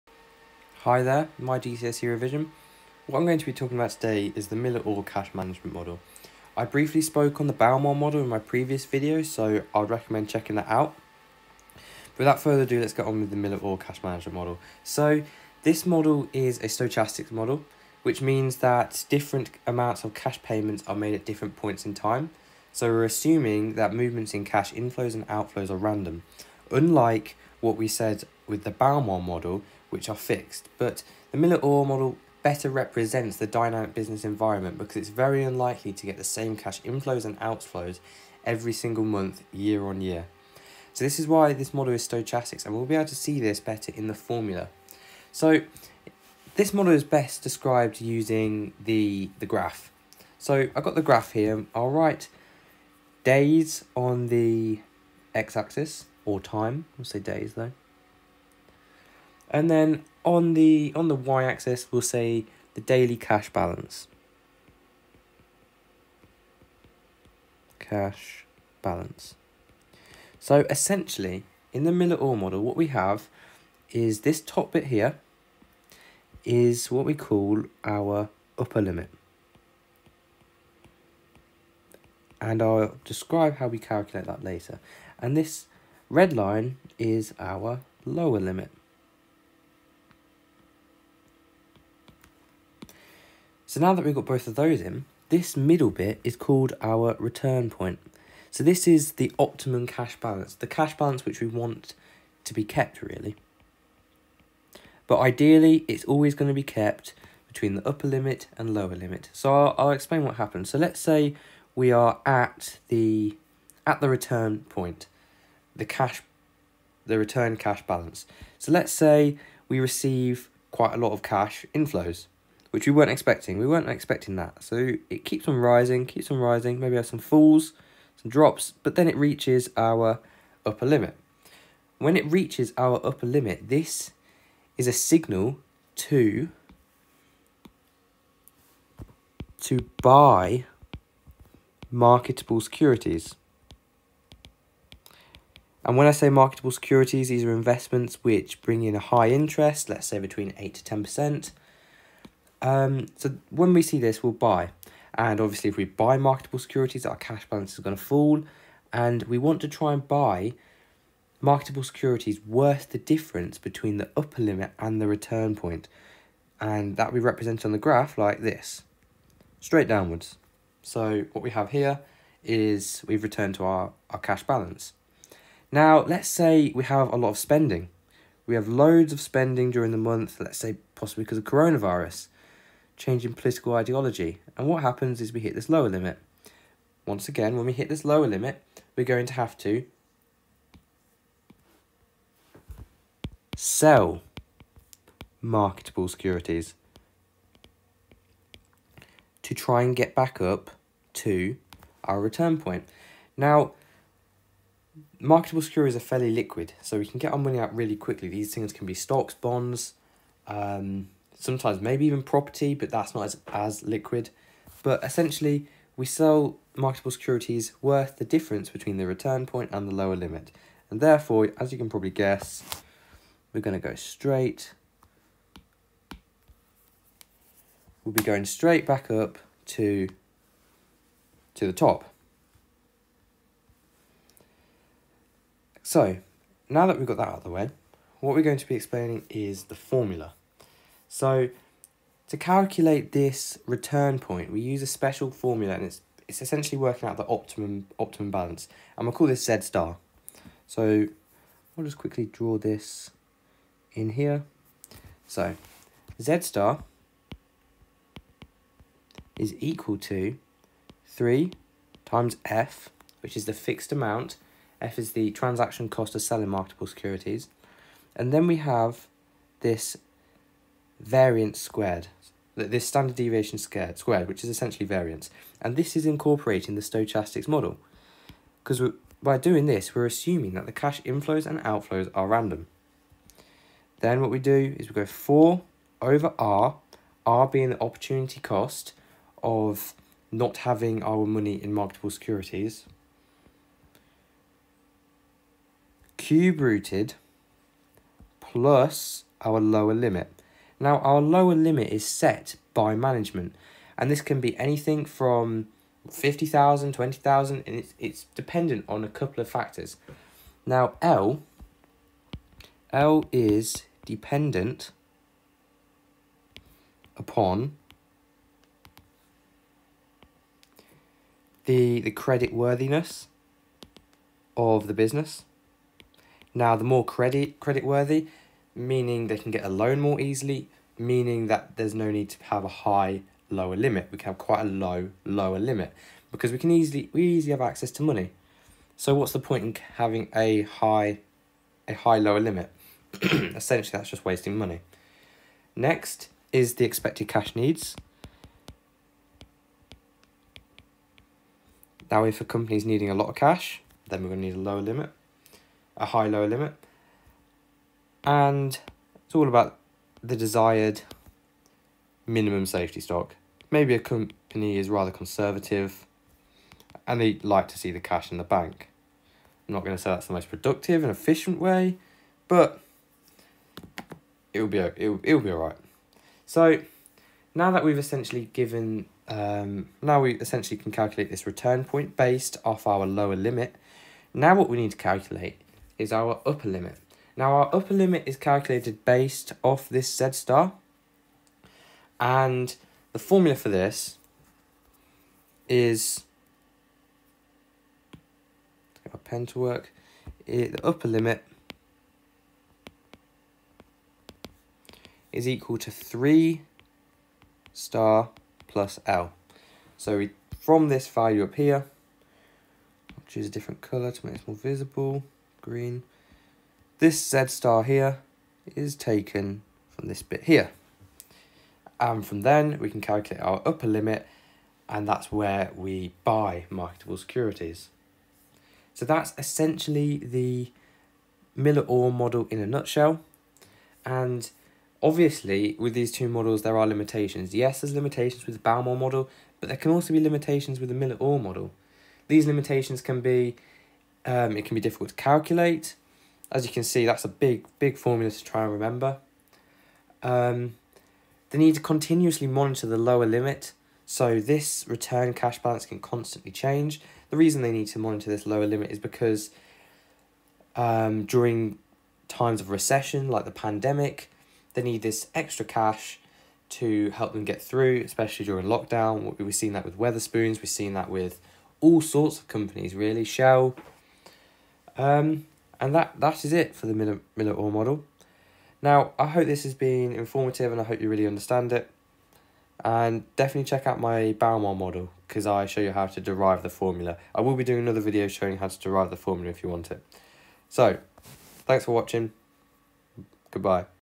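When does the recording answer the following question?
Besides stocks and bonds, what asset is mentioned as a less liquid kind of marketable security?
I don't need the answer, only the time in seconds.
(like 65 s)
212 s.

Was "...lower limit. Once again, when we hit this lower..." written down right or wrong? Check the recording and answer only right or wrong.
right.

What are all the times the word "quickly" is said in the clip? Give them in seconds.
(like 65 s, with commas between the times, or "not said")
207 s, 251 s.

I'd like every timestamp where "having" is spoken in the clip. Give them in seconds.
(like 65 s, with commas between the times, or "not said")
290 s, 339 s.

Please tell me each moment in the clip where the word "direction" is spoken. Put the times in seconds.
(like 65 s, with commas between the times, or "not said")
not said.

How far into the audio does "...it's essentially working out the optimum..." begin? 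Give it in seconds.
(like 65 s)
246 s.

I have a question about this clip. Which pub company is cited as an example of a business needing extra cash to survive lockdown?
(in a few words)
Wetherspoons.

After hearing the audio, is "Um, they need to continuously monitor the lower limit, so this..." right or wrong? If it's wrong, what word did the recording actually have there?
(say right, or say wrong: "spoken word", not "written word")
right.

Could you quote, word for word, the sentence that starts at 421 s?
And from then we can calculate our upper limit and that's where we buy marketable securities.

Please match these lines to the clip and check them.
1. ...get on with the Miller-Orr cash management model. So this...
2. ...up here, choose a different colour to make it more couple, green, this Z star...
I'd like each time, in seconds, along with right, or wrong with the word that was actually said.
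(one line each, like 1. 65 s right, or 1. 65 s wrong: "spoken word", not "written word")
1. 12 s right
2. 411 s wrong: "visible", not "couple".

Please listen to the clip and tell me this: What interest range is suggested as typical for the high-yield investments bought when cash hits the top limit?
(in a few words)
8 to 10%.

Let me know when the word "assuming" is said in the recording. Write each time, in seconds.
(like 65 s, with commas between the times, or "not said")
23 s, 280 s.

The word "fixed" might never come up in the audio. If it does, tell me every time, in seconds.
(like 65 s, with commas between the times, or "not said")
30 s, 263 s.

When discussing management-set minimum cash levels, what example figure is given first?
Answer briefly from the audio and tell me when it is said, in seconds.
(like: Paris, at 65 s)
50,000, at 306 s.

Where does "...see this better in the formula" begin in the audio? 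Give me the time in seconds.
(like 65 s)
43 s.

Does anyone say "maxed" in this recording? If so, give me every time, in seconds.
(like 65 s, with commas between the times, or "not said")
not said.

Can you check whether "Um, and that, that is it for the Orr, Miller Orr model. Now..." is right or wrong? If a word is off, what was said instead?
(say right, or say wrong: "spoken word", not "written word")
wrong: "Miller", not "Orr".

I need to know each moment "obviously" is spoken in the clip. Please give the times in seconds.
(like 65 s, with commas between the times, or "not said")
155 s, 435 s.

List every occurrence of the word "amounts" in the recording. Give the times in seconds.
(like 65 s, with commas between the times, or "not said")
19 s, 263 s.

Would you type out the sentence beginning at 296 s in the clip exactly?
Cube rooted plus our lower limit.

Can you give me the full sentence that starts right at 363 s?
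Maybe a company is rather conservative and they like to see the cash in the bank.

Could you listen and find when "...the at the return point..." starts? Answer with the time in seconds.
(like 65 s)
112 s.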